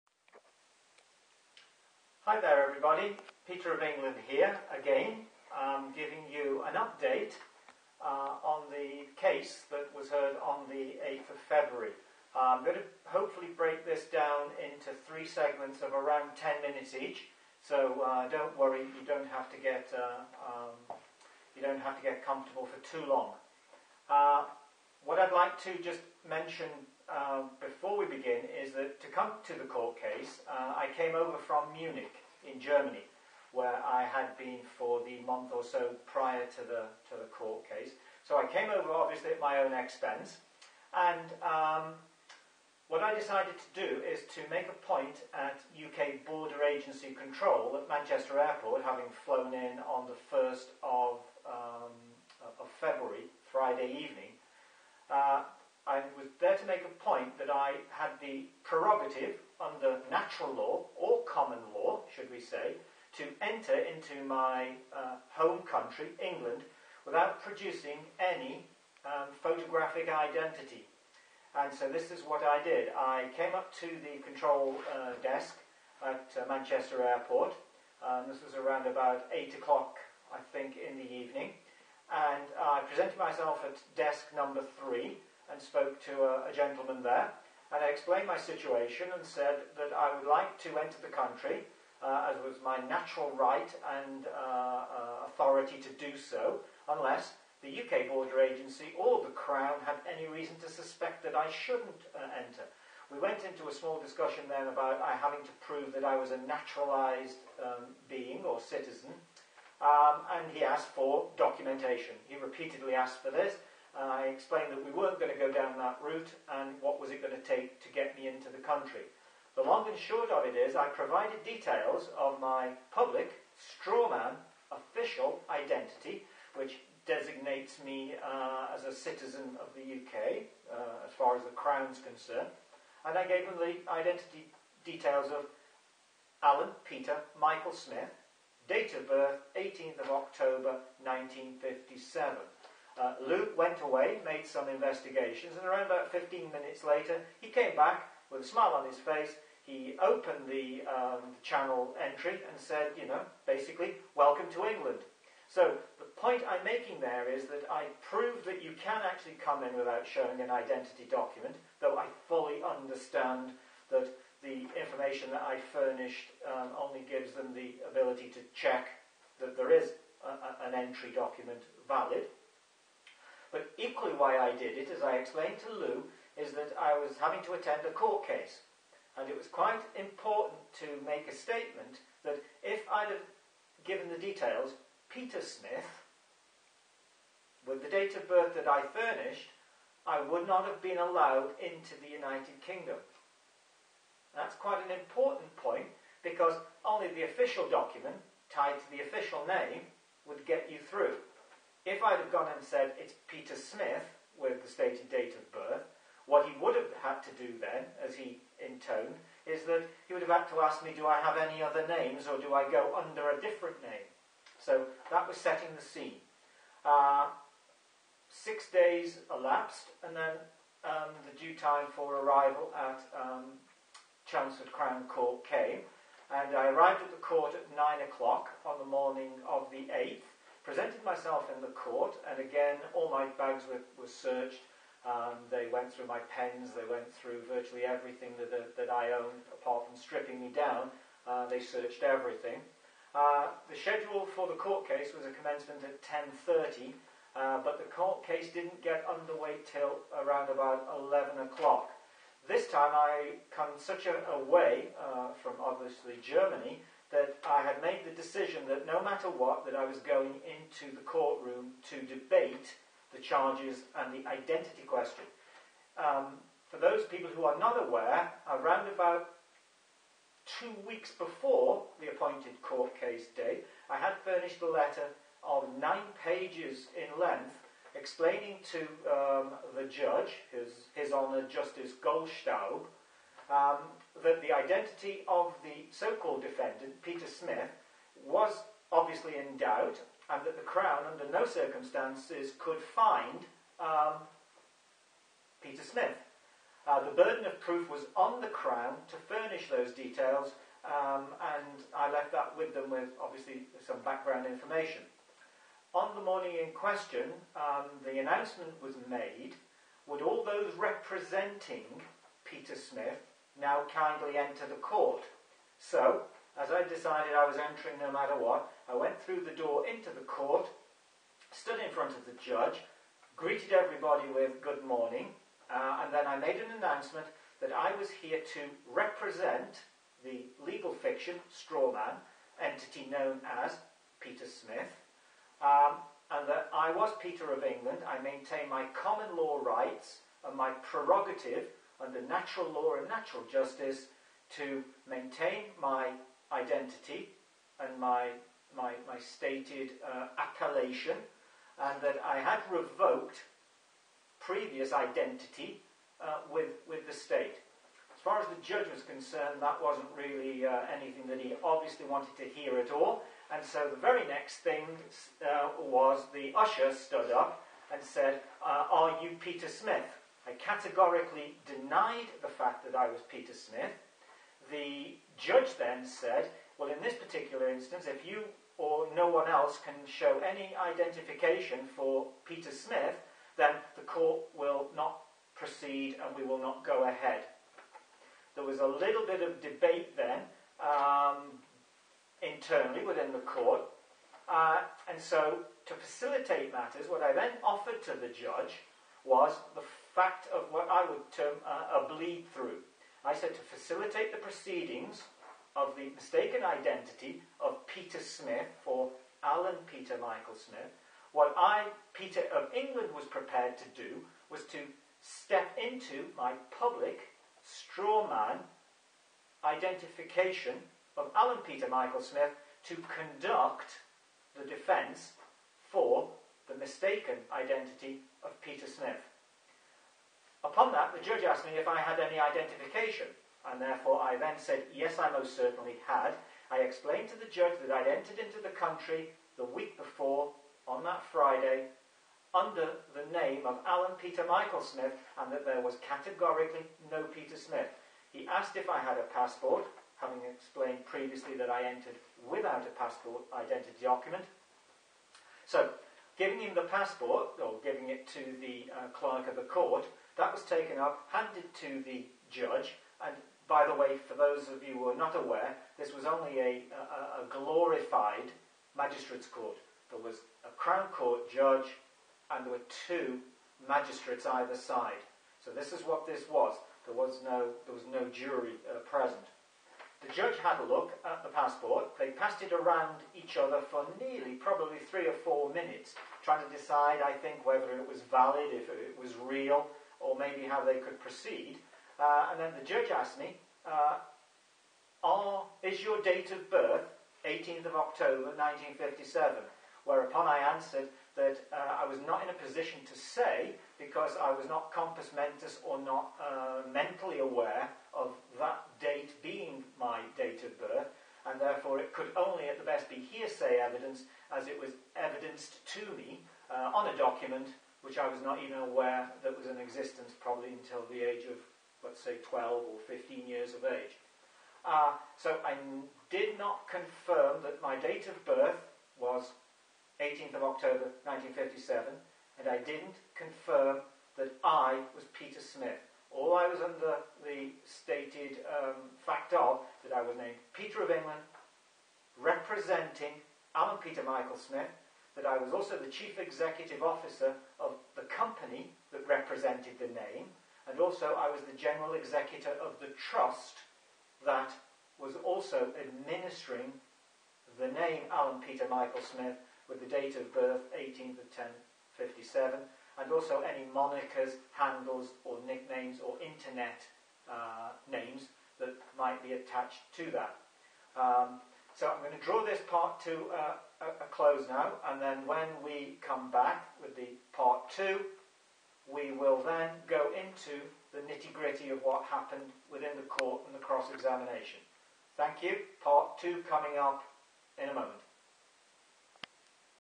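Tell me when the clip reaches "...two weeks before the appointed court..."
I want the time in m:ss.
4:30.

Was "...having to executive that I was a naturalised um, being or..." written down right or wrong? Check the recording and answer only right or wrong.
wrong.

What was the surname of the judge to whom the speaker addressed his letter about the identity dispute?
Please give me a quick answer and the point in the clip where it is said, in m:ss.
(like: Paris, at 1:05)
Goldstaub, at 4:42.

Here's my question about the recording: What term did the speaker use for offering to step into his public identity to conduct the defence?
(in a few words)
bleed through.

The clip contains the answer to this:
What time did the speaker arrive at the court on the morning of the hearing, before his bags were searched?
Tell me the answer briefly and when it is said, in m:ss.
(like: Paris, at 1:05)
9 o'clock, at 3:47.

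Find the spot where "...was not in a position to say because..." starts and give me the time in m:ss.
8:22.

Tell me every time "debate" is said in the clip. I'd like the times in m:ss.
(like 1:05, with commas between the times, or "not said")
4:22, 6:29.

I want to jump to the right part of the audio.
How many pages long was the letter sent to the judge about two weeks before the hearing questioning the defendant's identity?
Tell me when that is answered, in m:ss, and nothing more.
4:35.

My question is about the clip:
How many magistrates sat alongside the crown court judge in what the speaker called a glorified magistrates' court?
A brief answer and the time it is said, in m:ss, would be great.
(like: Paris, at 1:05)
2, at 7:53.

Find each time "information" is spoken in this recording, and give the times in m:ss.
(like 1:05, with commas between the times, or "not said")
2:44, 5:04.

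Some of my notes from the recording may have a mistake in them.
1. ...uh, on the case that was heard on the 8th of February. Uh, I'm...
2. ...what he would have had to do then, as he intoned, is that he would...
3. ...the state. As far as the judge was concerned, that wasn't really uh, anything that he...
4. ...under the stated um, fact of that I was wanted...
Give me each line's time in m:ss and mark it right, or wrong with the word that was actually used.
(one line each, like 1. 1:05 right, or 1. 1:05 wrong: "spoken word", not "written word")
1. 0:07 right
2. 3:26 right
3. 5:57 right
4. 8:56 wrong: "named", not "wanted".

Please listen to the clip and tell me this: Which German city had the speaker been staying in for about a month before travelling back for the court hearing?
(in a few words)
Munich.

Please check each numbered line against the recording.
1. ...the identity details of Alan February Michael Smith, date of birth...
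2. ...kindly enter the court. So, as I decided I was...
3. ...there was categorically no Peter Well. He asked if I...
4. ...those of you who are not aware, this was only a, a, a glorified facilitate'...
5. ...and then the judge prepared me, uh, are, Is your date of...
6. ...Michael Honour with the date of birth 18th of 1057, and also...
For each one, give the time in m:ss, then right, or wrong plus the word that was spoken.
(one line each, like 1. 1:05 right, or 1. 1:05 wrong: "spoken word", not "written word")
1. 2:13 wrong: "Peter", not "February"
2. 5:13 right
3. 7:25 wrong: "Smith", not "Well"
4. 7:44 wrong: "magistrates", not "facilitate"
5. 8:12 wrong: "asked", not "prepared"
6. 9:18 wrong: "Smith", not "Honour".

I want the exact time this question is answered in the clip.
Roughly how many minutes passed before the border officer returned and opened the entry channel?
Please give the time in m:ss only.
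2:26.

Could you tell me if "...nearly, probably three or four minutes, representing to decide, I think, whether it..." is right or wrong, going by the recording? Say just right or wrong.
wrong.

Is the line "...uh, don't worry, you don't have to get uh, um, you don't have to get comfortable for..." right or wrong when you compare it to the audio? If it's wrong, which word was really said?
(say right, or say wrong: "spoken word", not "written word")
right.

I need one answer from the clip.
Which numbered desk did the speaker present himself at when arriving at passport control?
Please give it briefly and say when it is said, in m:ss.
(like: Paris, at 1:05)
3, at 1:23.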